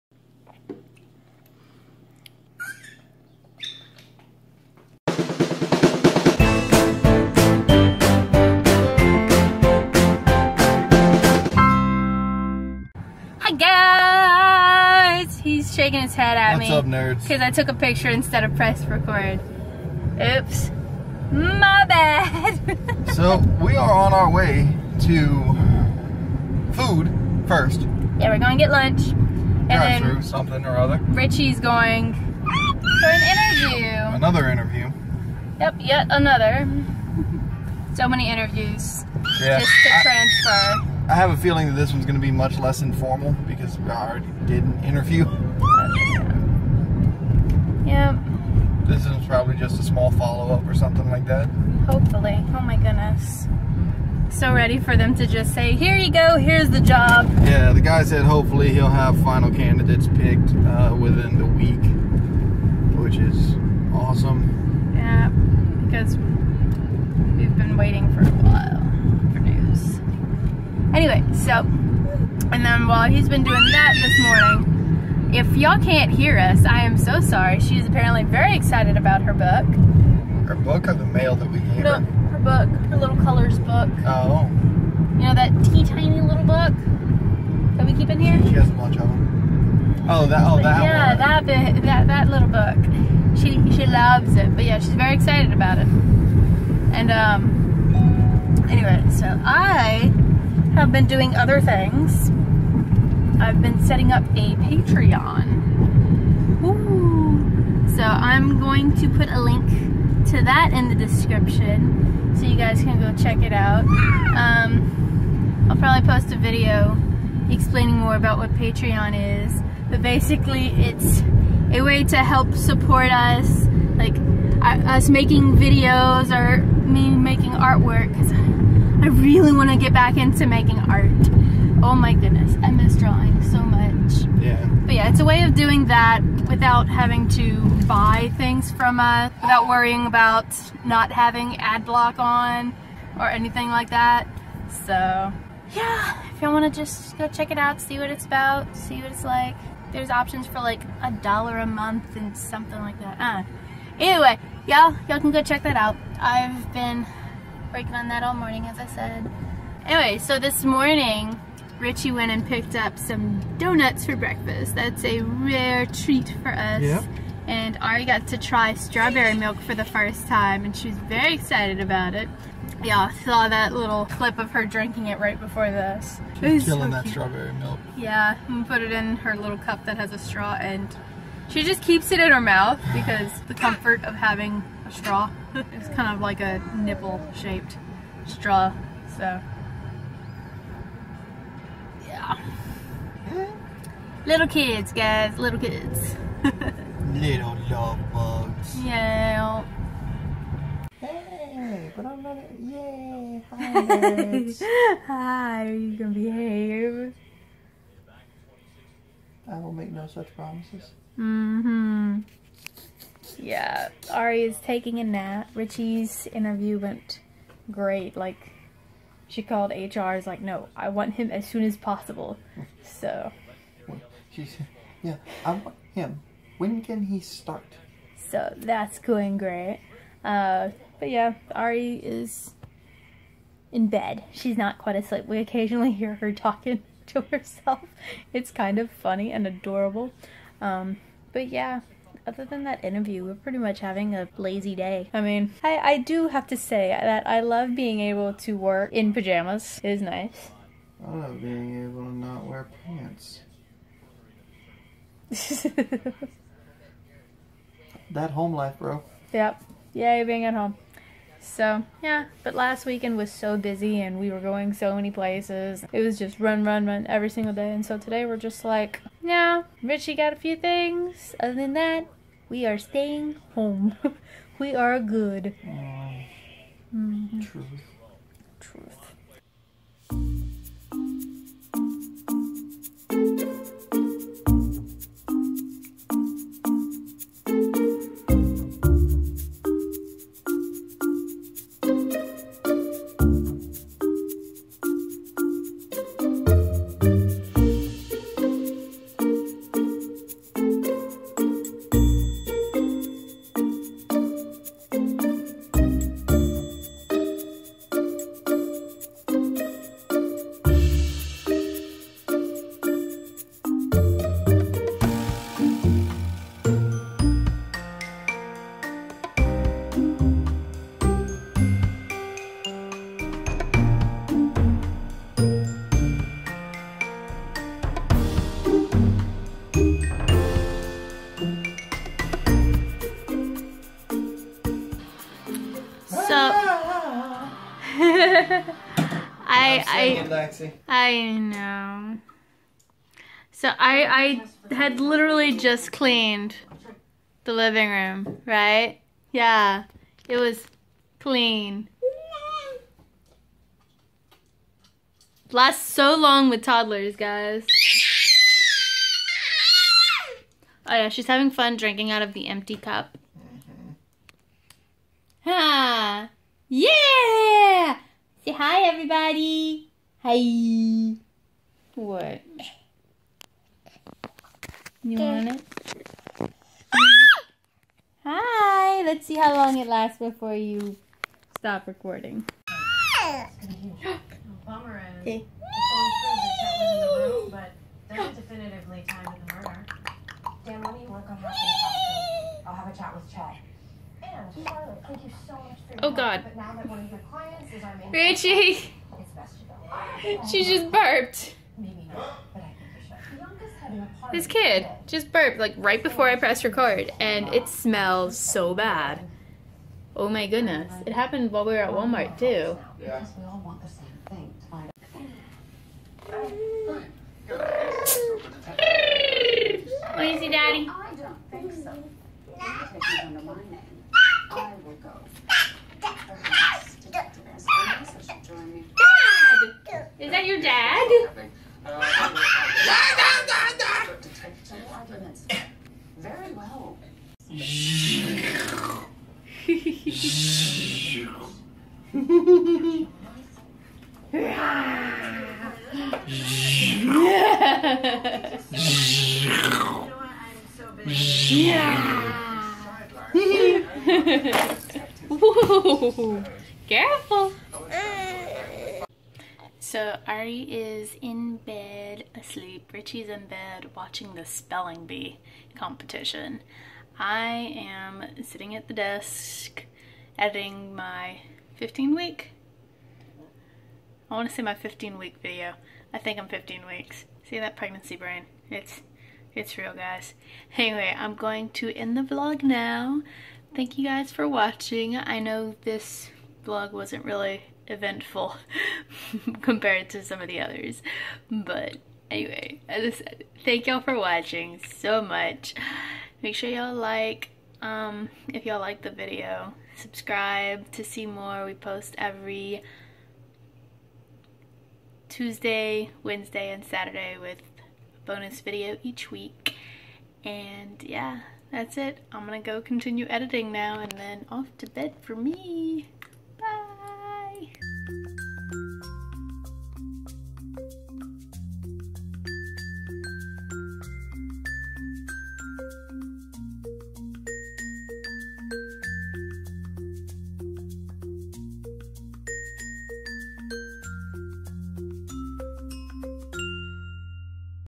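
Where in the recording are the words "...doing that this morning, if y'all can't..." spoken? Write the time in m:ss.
1:13.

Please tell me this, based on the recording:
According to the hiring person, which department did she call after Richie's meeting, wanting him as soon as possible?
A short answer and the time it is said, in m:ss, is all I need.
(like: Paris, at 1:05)
HR, at 3:39.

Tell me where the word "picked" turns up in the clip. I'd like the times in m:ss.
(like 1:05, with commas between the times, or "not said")
1:00, 2:42.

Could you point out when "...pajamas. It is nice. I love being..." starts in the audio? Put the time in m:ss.
4:09.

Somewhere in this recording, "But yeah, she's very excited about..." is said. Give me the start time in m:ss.
1:34.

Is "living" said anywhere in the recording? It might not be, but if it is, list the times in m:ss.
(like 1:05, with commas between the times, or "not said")
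5:47.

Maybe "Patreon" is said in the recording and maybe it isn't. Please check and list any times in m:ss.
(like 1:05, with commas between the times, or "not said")
1:44, 1:58.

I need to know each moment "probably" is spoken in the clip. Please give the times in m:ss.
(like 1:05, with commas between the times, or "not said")
0:49, 1:55.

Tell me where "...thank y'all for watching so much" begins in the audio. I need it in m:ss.
8:13.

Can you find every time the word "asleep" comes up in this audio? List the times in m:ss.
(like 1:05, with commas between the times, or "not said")
3:54, 7:42.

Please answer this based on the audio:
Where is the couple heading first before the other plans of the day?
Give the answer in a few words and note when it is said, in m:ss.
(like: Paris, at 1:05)
Lunch, at 0:28.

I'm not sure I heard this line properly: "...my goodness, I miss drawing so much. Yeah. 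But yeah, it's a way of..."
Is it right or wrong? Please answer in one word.
right.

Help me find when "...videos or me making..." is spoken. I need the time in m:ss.
2:05.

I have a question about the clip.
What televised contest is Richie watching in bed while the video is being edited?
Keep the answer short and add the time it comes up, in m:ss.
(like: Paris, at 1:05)
Spelling bee, at 7:44.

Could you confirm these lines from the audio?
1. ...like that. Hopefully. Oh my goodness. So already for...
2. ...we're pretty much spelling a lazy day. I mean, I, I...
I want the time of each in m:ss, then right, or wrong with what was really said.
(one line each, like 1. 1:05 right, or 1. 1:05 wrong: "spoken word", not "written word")
1. 0:51 wrong: "ready", not "already"
2. 4:03 wrong: "having", not "spelling".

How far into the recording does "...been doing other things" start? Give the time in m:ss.
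1:40.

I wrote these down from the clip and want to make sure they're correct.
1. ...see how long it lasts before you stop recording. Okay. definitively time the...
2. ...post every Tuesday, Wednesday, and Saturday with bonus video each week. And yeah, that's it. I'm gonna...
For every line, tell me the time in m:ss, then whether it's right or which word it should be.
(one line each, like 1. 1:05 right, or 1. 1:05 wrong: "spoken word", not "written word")
1. 6:19 right
2. 8:21 right.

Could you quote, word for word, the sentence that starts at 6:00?
Oh yeah, she's having fun drinking out of the empty cup.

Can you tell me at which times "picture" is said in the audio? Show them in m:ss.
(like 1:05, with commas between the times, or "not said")
0:17.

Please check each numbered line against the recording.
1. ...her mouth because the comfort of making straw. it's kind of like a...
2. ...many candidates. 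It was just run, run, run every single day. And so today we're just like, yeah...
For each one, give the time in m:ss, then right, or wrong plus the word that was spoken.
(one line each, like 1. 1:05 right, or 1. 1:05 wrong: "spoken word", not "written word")
1. 3:02 wrong: "having", not "making"
2. 4:24 wrong: "places", not "candidates".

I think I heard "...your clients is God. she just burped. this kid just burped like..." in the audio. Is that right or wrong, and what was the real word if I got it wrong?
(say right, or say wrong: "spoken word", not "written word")
wrong: "Richie", not "God".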